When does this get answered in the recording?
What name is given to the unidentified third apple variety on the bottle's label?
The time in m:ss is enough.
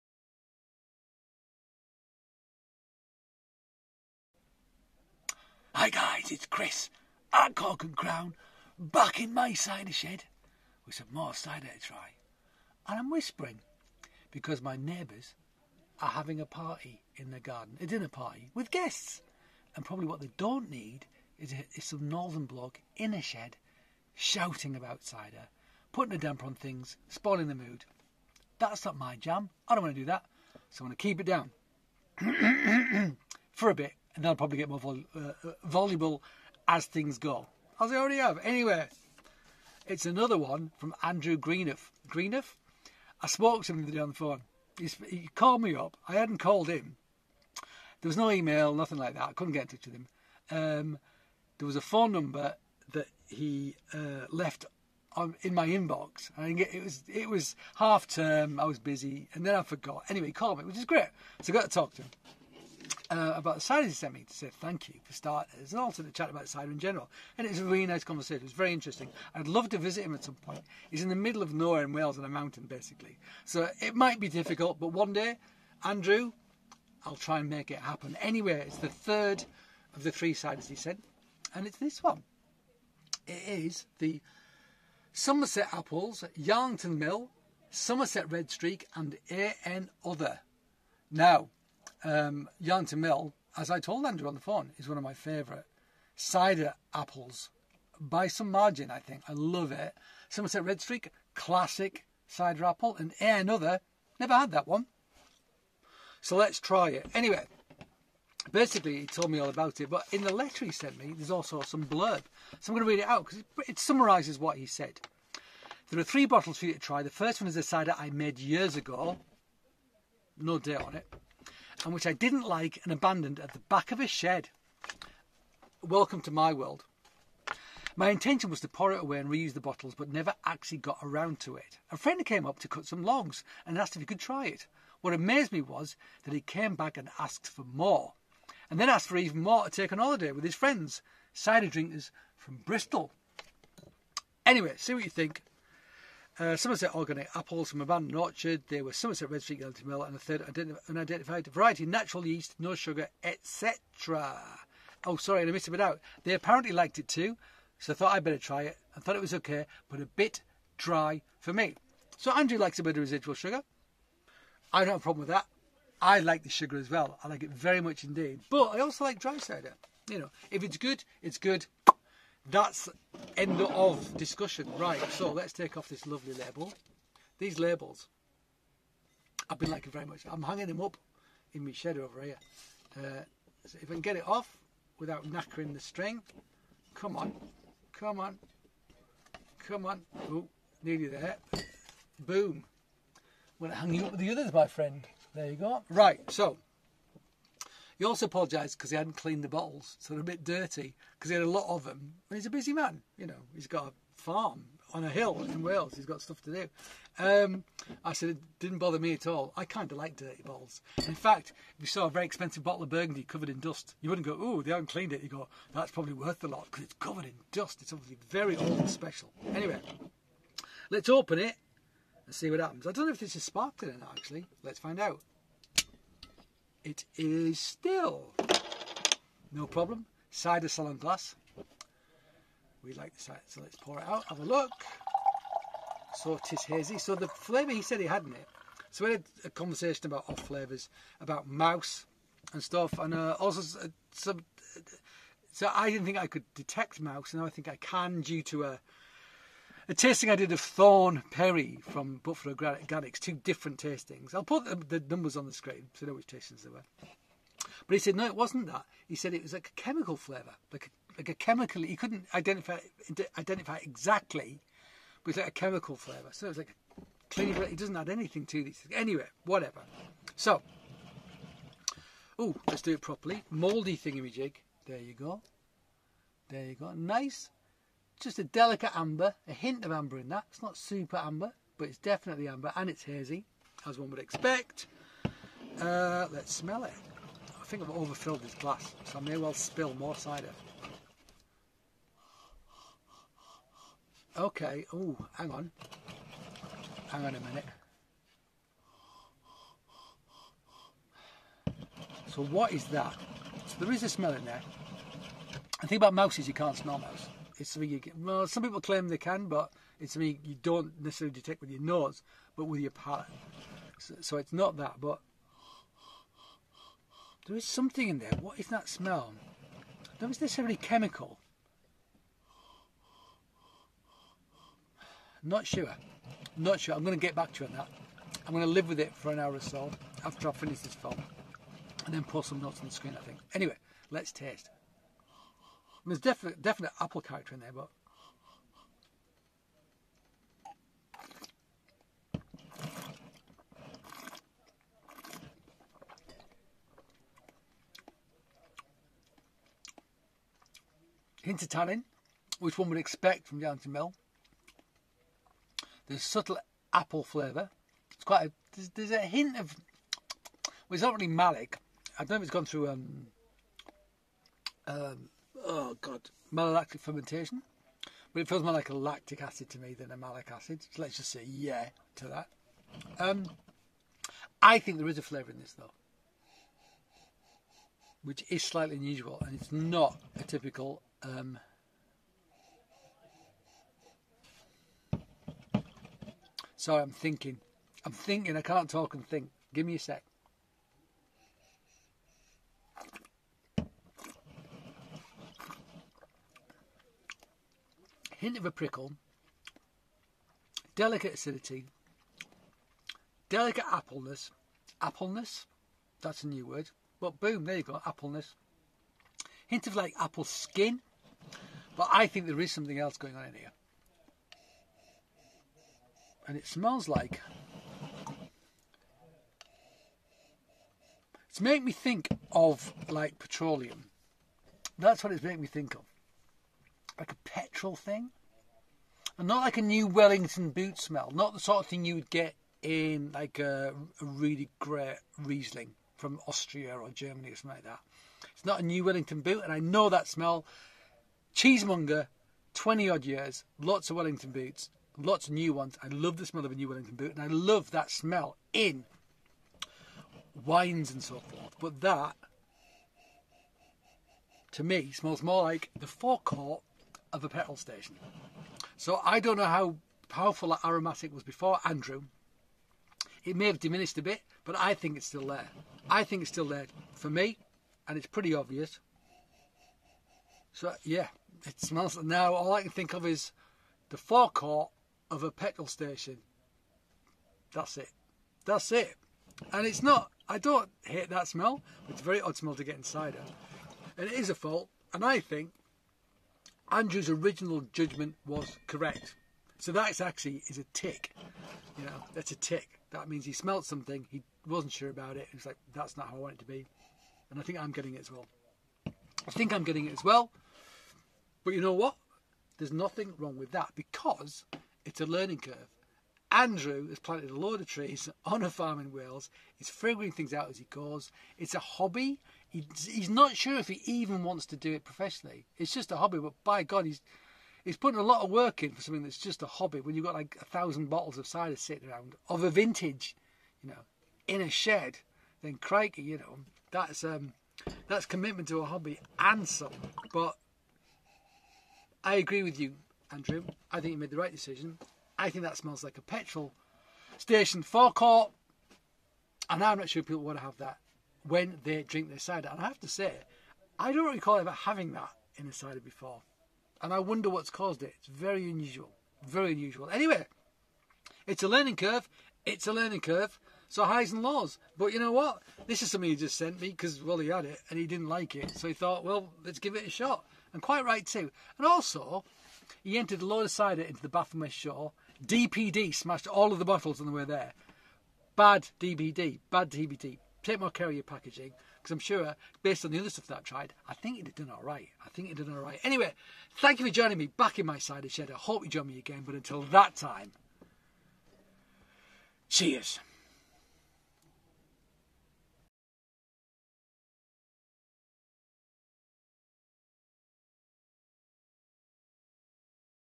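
1:29.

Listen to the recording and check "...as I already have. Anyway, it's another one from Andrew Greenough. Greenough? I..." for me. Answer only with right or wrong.
right.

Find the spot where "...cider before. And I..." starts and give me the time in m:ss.
9:05.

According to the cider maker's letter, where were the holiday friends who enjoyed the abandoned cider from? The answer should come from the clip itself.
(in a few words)
Bristol.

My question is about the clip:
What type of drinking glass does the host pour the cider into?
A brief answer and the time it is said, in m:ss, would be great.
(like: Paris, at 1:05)
Cider salon glass, at 3:50.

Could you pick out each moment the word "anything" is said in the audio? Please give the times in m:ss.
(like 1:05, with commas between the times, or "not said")
4:28.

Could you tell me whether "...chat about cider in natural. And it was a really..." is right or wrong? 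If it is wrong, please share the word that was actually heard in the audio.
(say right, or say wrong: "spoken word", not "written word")
wrong: "general", not "natural".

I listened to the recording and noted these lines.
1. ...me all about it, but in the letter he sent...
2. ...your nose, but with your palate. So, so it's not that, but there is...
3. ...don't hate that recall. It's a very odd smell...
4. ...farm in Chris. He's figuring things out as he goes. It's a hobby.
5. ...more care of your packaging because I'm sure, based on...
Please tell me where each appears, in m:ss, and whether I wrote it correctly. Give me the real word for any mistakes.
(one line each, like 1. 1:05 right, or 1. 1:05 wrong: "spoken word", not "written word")
1. 1:49 right
2. 5:11 right
3. 8:00 wrong: "smell", not "recall"
4. 8:28 wrong: "Wales", not "Chris"
5. 9:30 right.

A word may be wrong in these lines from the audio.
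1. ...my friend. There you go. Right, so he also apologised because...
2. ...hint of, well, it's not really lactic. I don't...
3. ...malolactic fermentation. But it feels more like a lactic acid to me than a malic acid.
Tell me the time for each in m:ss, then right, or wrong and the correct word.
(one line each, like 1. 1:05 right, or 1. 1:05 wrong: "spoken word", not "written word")
1. 3:14 right
2. 5:59 wrong: "malic", not "lactic"
3. 6:06 right.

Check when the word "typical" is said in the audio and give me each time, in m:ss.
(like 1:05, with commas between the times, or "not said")
6:20.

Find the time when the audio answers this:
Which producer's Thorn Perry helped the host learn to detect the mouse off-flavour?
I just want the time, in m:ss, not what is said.
4:12.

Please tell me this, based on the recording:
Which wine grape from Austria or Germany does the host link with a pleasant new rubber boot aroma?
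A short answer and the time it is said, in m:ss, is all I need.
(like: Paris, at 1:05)
Riesling, at 7:15.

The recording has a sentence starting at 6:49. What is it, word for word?
Hint of like apple skin, but I think there is something else going on in here.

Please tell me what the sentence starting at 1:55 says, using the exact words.
There are three bottles for you to try.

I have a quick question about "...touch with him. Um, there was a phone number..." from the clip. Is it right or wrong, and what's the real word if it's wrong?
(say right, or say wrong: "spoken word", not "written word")
right.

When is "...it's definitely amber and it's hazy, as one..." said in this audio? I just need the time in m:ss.
4:41.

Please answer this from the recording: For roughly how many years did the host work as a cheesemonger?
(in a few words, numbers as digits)
20.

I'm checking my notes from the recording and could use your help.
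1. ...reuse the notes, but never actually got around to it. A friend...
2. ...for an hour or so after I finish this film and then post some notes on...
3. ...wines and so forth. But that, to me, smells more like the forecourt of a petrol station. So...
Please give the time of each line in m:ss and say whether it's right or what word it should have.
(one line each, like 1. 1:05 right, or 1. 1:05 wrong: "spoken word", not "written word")
1. 2:09 wrong: "bottles", not "notes"
2. 5:29 right
3. 7:30 right.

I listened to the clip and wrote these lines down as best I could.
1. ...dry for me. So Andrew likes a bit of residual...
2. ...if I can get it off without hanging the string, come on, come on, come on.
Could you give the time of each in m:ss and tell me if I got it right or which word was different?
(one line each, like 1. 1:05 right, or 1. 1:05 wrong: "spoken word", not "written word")
1. 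2:40 right
2. 3:03 wrong: "knackering", not "hanging".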